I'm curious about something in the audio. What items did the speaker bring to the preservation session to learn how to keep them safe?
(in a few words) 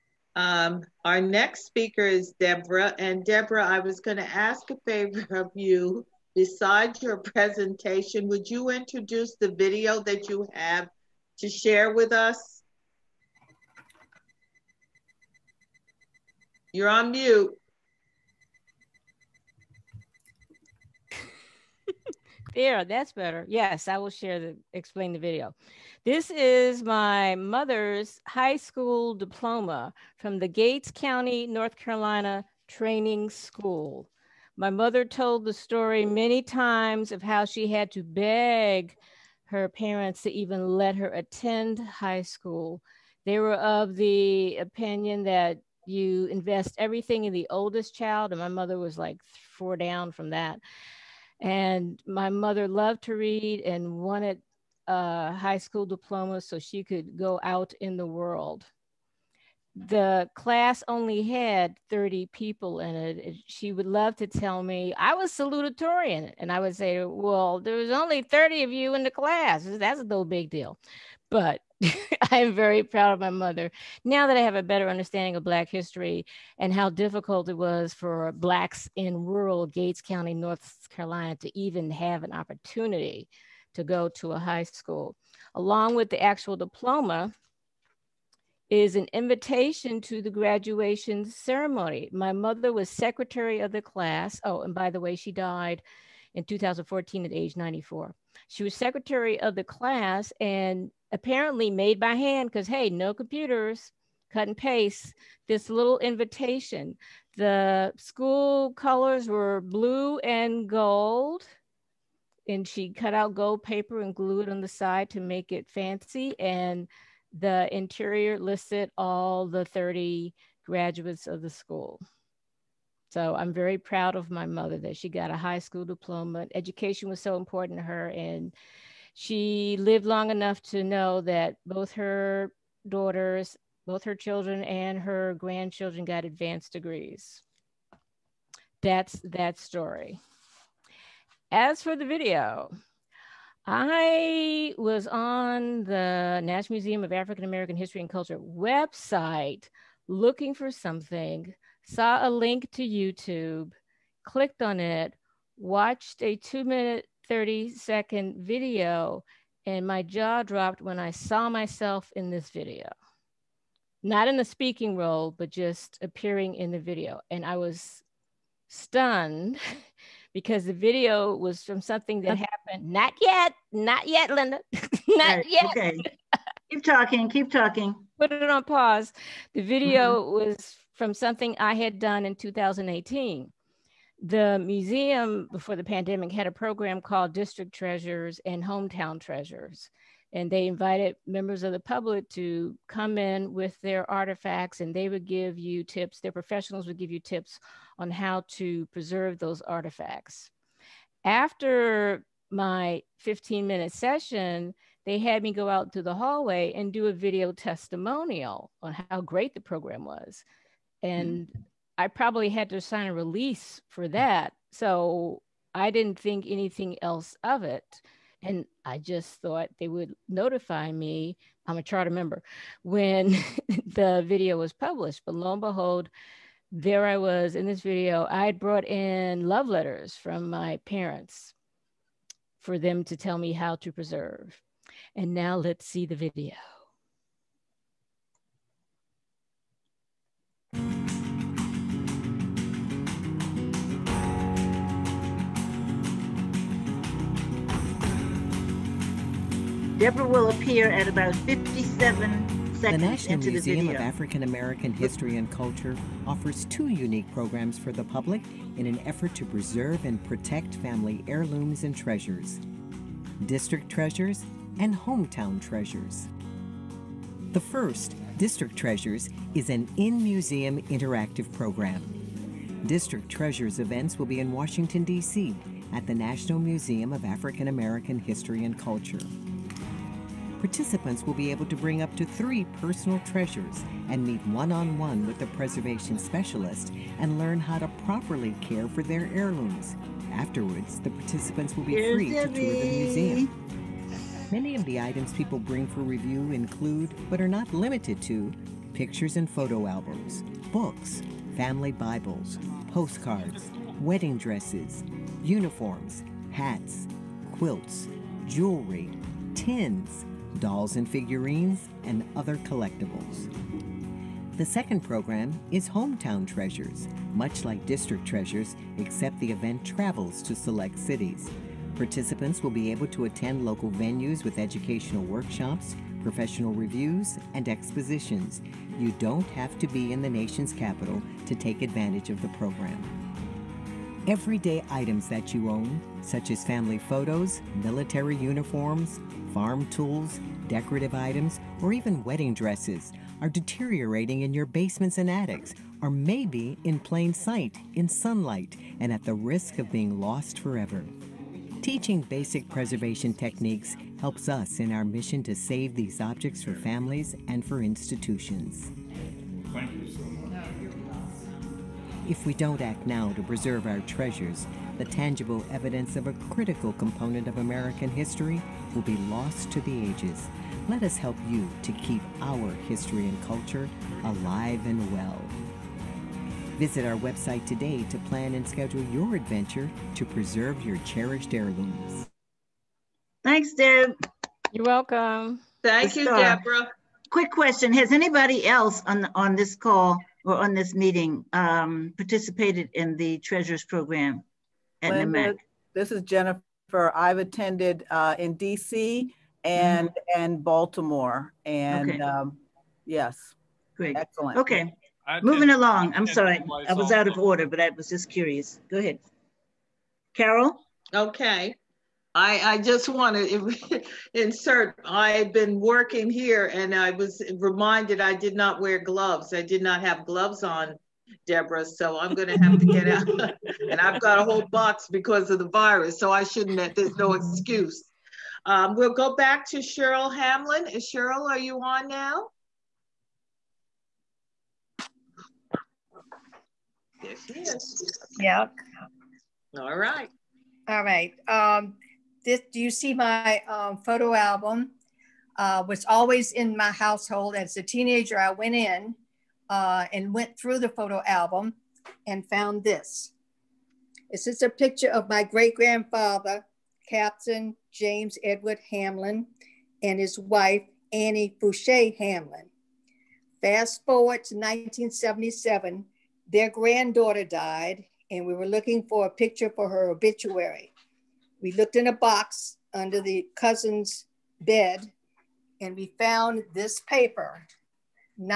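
love letters.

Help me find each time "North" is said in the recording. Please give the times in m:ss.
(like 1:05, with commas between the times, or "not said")
0:31, 1:20.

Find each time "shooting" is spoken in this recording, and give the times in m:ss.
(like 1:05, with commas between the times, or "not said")
not said.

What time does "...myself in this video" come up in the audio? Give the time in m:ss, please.
2:41.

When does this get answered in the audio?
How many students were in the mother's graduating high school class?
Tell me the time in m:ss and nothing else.
1:01.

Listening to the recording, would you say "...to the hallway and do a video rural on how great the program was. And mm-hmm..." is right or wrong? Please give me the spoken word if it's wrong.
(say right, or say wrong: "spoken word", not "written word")
wrong: "testimonial", not "rural".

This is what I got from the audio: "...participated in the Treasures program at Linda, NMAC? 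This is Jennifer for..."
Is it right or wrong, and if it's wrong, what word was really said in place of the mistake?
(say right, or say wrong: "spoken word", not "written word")
right.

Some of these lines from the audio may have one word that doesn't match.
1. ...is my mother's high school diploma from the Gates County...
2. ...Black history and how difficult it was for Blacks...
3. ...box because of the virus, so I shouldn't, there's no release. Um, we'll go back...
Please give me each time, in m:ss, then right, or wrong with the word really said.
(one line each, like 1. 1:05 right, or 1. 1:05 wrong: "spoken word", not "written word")
1. 0:26 right
2. 1:15 right
3. 7:04 wrong: "excuse", not "release".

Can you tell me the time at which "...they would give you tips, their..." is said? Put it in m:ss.
3:14.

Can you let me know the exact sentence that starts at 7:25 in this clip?
Uh, was always in my household.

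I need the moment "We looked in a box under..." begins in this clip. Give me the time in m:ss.
7:51.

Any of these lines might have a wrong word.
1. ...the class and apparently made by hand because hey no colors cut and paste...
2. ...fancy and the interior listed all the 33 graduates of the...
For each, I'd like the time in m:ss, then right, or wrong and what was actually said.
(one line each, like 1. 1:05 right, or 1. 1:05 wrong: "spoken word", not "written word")
1. 1:39 wrong: "computers", not "colors"
2. 1:55 wrong: "30", not "33".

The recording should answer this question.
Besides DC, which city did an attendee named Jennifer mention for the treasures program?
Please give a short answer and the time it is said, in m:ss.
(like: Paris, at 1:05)
Baltimore, at 6:40.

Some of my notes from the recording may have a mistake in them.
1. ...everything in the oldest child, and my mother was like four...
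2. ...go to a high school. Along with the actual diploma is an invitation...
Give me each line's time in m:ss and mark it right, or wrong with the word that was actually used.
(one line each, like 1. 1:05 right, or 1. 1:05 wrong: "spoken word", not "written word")
1. 0:46 right
2. 1:23 right.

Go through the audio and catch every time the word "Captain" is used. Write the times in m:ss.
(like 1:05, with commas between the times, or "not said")
7:37.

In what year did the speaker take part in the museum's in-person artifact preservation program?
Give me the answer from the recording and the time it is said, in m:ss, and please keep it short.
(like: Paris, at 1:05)
2018, at 3:02.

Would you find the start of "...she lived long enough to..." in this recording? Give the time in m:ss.
2:09.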